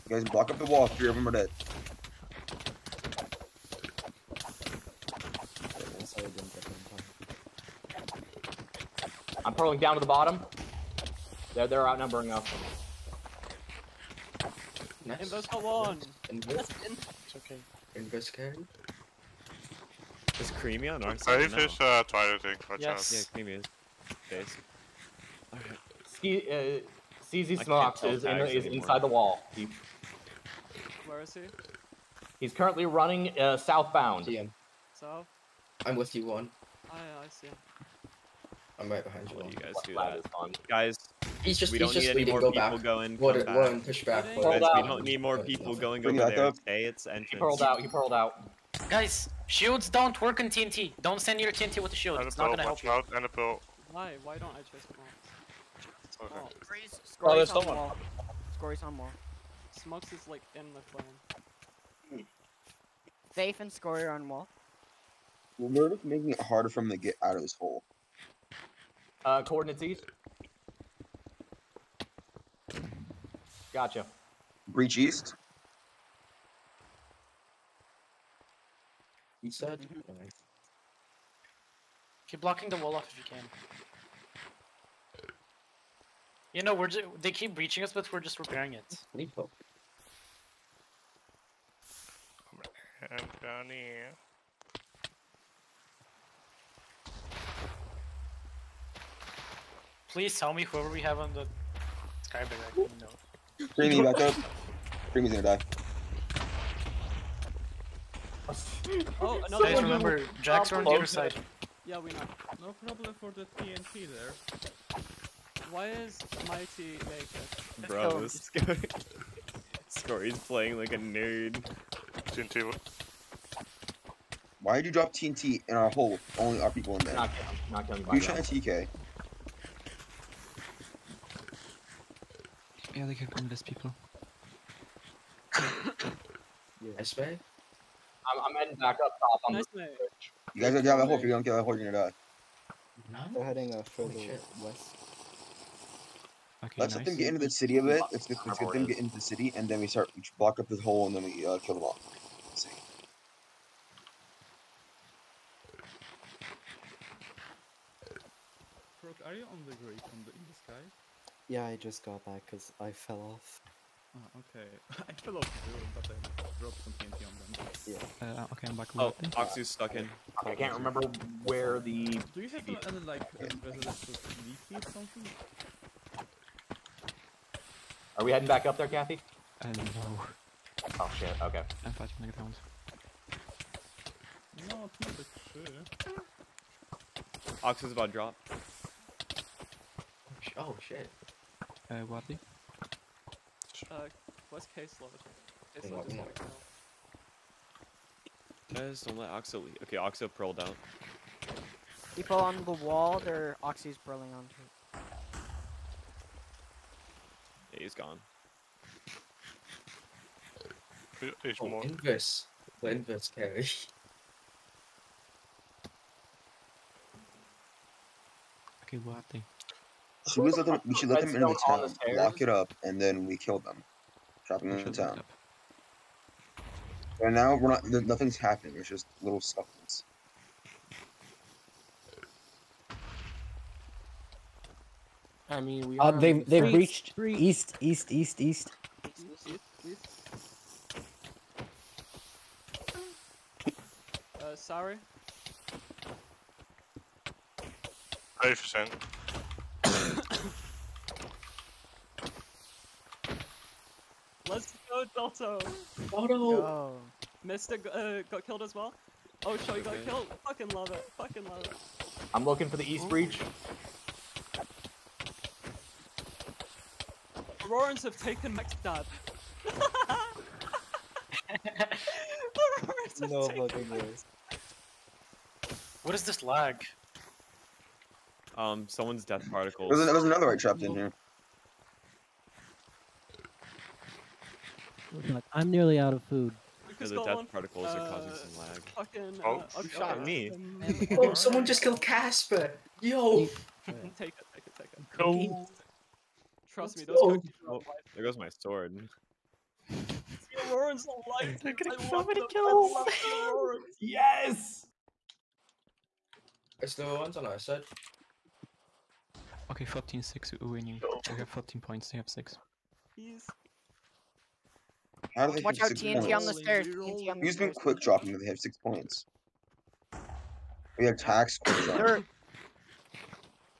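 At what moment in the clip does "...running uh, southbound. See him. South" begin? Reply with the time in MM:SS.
00:32.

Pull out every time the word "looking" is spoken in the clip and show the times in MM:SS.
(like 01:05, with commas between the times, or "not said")
04:22.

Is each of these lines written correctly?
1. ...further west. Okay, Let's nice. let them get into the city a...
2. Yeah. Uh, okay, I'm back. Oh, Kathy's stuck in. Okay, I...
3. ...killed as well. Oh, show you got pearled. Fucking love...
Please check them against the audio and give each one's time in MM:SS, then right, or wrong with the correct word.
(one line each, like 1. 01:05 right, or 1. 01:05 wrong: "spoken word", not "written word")
1. 02:23 right
2. 02:48 wrong: "Oxy", not "Kathy"
3. 04:18 wrong: "killed", not "pearled".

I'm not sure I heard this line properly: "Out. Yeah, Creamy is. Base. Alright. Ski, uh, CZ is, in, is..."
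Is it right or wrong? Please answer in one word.
right.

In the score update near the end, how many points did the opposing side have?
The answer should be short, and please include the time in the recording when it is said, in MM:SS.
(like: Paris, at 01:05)
6, at 05:12.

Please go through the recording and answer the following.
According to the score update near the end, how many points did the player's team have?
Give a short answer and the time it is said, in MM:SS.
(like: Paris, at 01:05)
14, at 05:11.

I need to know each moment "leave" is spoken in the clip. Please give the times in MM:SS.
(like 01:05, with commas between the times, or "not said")
01:29, 03:19.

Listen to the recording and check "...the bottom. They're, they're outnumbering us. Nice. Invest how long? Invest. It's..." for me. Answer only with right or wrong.
right.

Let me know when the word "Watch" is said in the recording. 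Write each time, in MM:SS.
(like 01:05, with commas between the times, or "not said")
00:22, 05:15.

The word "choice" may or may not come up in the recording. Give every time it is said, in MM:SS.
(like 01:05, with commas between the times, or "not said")
not said.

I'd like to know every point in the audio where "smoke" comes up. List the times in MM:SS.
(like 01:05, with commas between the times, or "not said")
00:54, 00:59.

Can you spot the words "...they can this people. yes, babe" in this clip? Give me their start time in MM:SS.
02:13.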